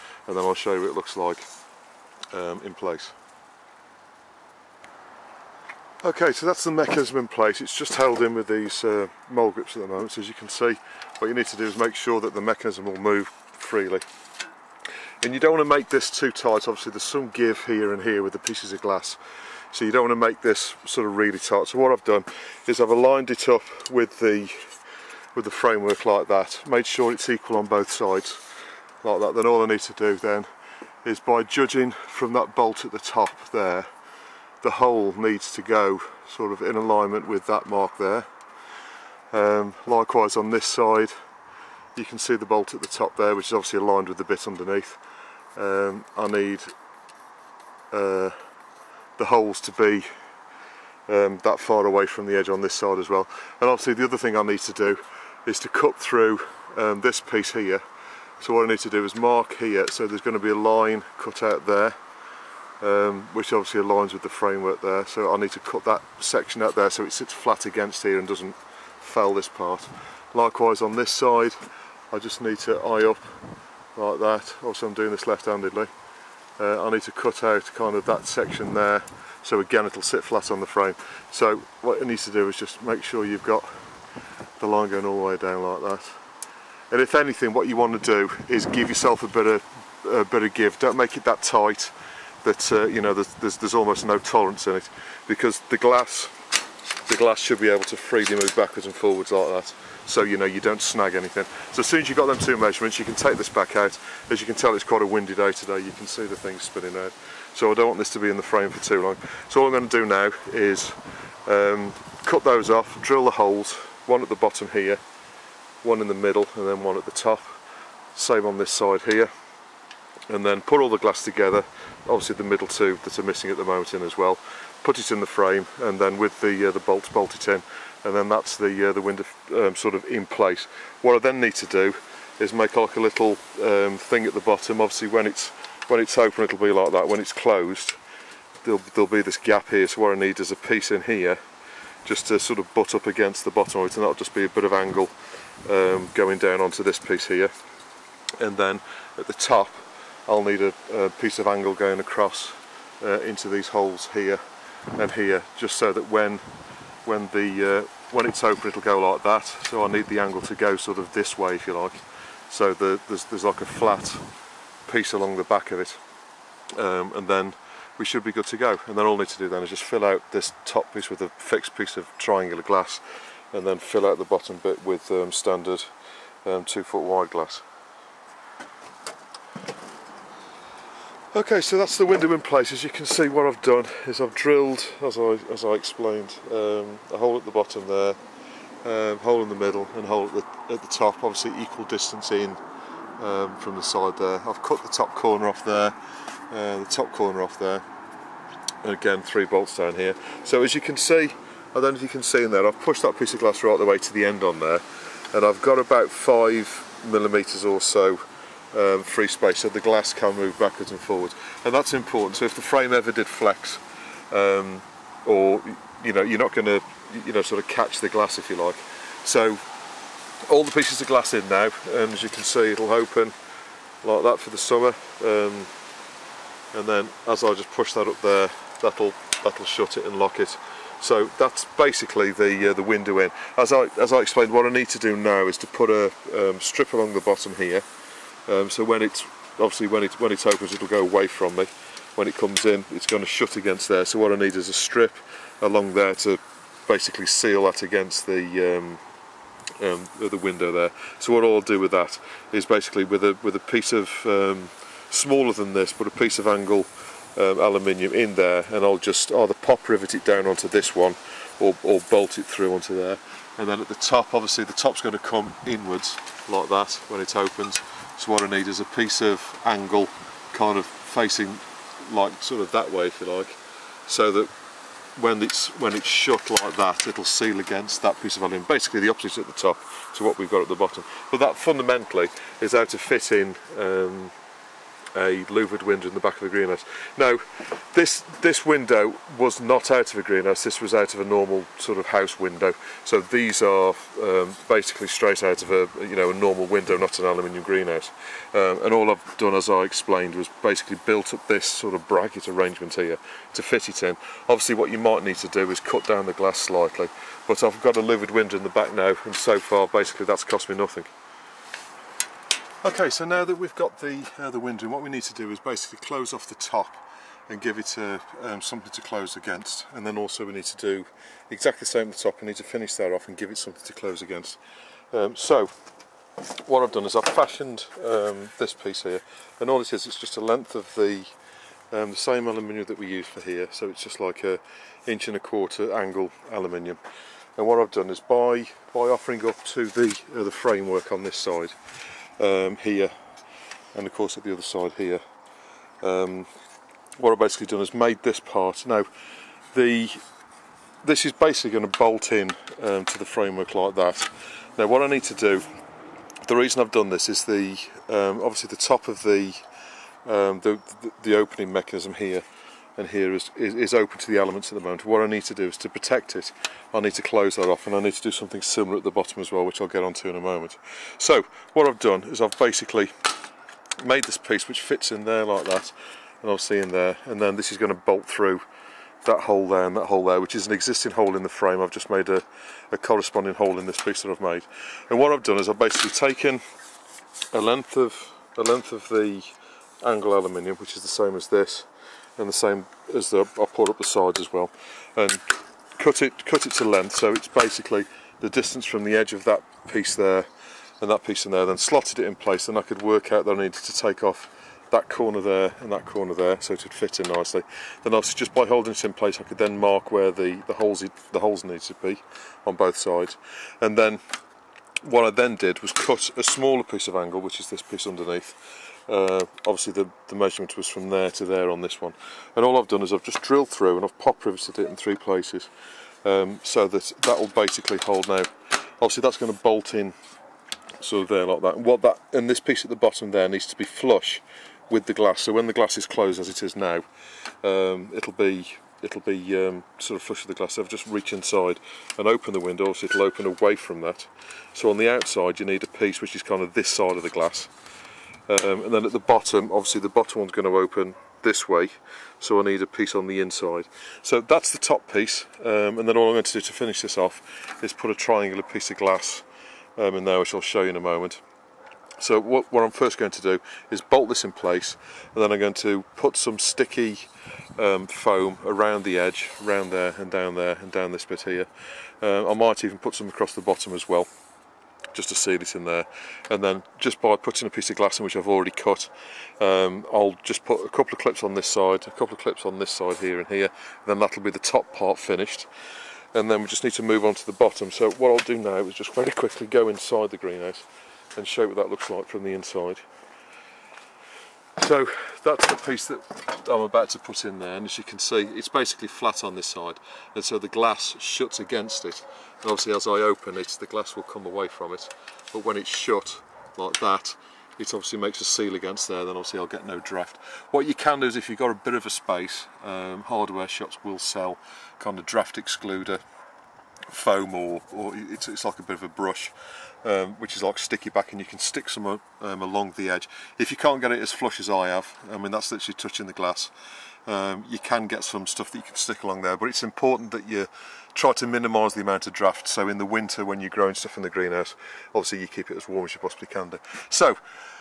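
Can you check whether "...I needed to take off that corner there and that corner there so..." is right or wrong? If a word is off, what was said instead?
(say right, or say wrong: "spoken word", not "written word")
right.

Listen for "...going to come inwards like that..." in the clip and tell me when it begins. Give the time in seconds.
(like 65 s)
265 s.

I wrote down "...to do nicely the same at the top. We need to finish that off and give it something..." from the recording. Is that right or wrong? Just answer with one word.
wrong.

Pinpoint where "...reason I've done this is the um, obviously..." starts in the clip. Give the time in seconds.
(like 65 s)
356 s.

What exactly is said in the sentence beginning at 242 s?
When it comes in, it's going to shut against there.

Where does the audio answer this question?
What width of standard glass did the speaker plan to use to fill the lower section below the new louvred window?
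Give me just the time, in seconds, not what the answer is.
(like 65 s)
176 s.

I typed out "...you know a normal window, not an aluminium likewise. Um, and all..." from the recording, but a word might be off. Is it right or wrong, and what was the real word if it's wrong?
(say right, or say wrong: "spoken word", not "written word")
wrong: "greenhouse", not "likewise".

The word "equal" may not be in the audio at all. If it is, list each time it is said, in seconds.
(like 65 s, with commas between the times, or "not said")
27 s, 191 s.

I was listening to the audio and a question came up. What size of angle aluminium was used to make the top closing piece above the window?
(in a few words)
inch and a quarter.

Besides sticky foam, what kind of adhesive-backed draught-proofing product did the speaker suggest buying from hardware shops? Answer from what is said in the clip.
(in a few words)
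brush.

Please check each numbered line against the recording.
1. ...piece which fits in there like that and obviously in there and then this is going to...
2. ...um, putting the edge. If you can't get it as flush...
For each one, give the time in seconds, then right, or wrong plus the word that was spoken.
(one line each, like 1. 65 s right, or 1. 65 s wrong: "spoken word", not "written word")
1. 374 s right
2. 522 s wrong: "along", not "putting".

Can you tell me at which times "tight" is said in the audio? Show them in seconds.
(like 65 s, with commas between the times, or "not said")
16 s, 21 s, 91 s.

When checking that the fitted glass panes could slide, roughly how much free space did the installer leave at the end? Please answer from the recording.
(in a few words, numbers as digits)
5 millimeters.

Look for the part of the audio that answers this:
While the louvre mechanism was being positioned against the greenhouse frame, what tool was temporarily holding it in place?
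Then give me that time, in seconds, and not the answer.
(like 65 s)
9 s.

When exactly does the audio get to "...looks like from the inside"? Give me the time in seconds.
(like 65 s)
491 s.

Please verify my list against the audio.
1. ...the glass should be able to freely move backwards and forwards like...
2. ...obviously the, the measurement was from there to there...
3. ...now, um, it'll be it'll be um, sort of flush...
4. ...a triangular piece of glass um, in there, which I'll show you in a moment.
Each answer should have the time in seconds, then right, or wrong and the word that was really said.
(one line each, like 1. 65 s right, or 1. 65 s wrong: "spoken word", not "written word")
1. 97 s right
2. 419 s right
3. 436 s right
4. 458 s right.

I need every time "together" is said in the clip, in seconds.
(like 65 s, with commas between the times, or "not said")
121 s.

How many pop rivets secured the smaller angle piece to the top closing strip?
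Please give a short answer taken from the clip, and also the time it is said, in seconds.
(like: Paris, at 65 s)
3, at 424 s.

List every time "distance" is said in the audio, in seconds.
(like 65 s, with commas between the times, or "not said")
191 s, 398 s.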